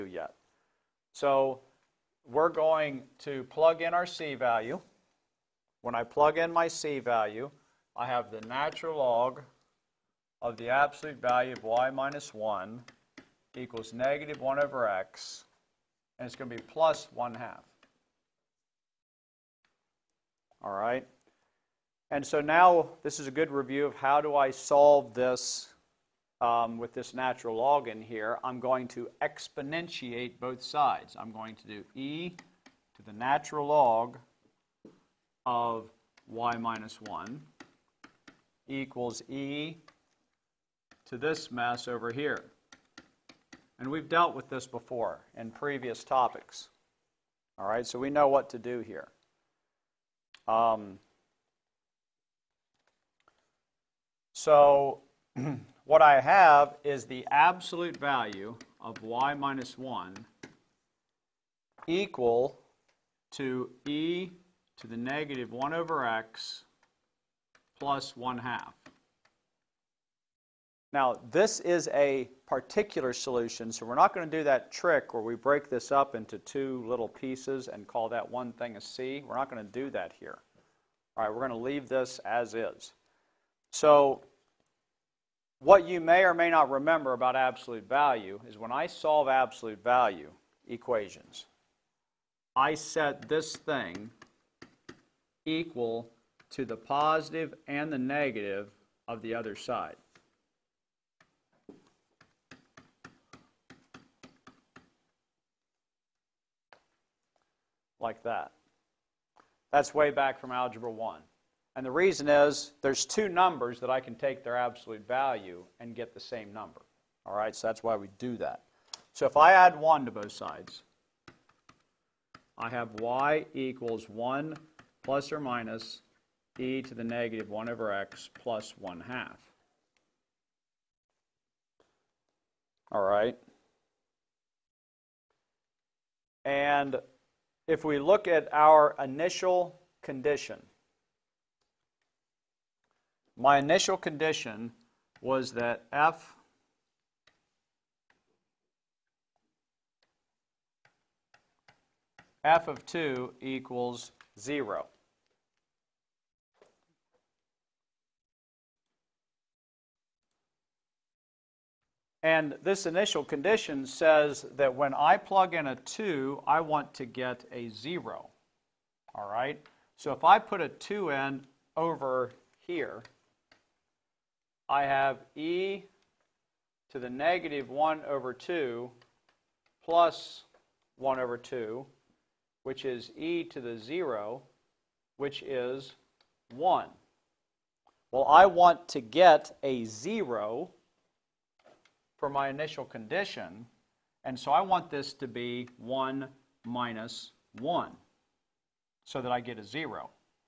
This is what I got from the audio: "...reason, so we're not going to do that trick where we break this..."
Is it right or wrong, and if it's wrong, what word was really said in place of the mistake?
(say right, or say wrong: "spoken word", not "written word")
wrong: "solution", not "reason".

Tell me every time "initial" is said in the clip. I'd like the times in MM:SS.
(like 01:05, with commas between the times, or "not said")
02:19, 02:23, 02:42, 03:12.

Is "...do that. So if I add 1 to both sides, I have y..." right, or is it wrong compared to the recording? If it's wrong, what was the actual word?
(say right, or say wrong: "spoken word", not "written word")
right.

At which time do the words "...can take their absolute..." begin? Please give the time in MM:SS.
01:54.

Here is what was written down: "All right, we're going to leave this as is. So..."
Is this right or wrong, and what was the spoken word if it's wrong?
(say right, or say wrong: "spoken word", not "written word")
right.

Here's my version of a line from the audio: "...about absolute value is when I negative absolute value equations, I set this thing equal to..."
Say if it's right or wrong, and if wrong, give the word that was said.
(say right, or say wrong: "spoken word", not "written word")
wrong: "solve", not "negative".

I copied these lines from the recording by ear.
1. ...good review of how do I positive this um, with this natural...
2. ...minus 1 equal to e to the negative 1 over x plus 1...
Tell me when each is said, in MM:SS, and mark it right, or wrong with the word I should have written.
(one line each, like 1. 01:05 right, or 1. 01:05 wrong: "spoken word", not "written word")
1. 00:23 wrong: "solve", not "positive"
2. 00:59 right.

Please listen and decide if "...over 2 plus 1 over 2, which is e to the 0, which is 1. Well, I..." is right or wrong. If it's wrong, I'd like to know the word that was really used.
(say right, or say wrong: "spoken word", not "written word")
right.